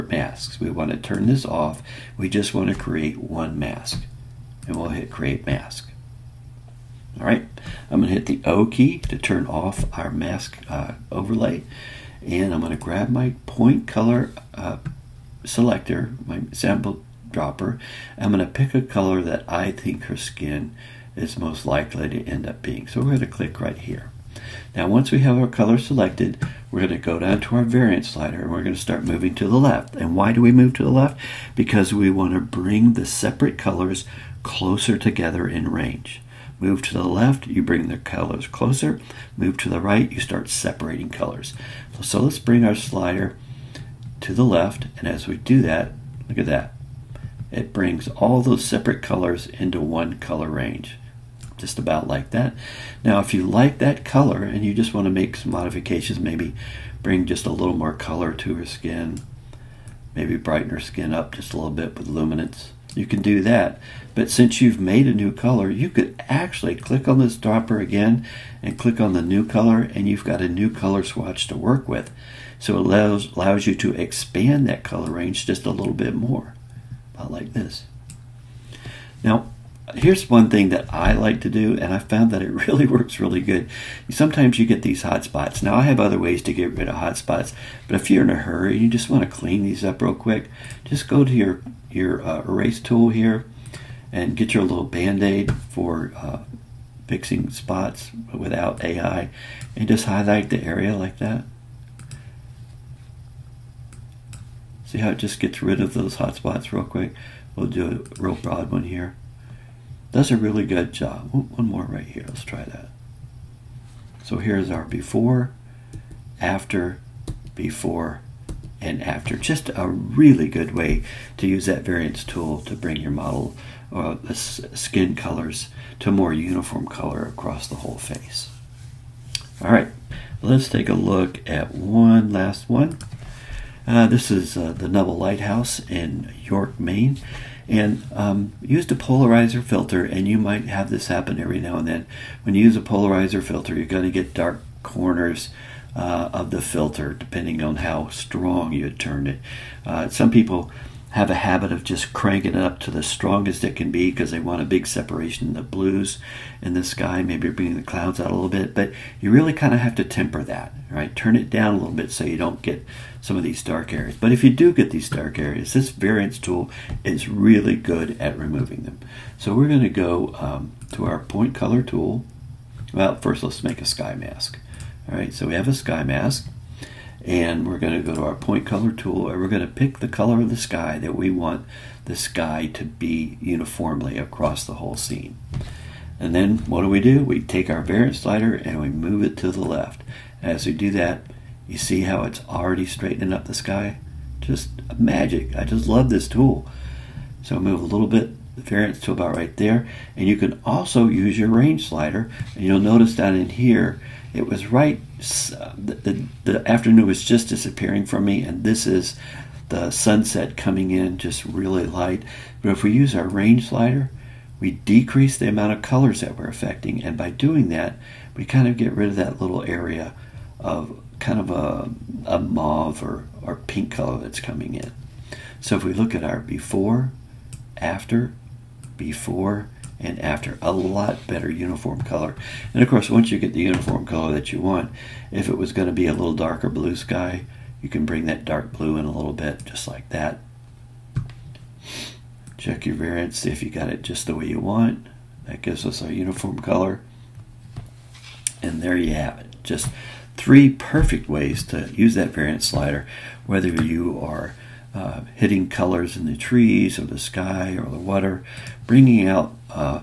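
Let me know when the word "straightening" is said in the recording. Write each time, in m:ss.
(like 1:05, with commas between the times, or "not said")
3:12.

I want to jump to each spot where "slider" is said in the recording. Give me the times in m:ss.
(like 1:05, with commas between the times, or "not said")
0:28, 0:42, 3:08, 3:21, 3:33, 4:12.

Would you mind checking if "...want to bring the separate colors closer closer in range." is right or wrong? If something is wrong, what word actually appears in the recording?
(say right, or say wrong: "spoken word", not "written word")
wrong: "together", not "closer".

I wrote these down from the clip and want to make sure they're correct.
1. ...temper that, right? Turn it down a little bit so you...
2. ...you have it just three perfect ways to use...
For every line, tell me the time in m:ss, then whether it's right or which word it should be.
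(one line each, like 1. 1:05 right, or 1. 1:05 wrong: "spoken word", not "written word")
1. 2:40 right
2. 4:08 right.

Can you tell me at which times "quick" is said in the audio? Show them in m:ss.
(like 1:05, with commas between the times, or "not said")
1:30, 1:46.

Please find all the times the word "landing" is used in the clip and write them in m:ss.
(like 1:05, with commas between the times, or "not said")
not said.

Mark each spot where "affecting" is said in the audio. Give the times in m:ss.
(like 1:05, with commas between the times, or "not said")
3:36.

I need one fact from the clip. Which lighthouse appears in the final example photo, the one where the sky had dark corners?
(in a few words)
Nubble Lighthouse.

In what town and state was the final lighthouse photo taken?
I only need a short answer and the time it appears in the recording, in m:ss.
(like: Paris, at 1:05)
York, Maine, at 2:16.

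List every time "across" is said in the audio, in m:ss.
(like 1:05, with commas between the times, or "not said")
2:07, 3:04.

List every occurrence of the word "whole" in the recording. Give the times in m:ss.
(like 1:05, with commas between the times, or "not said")
2:07, 3:04.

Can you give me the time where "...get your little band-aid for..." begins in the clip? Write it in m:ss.
1:34.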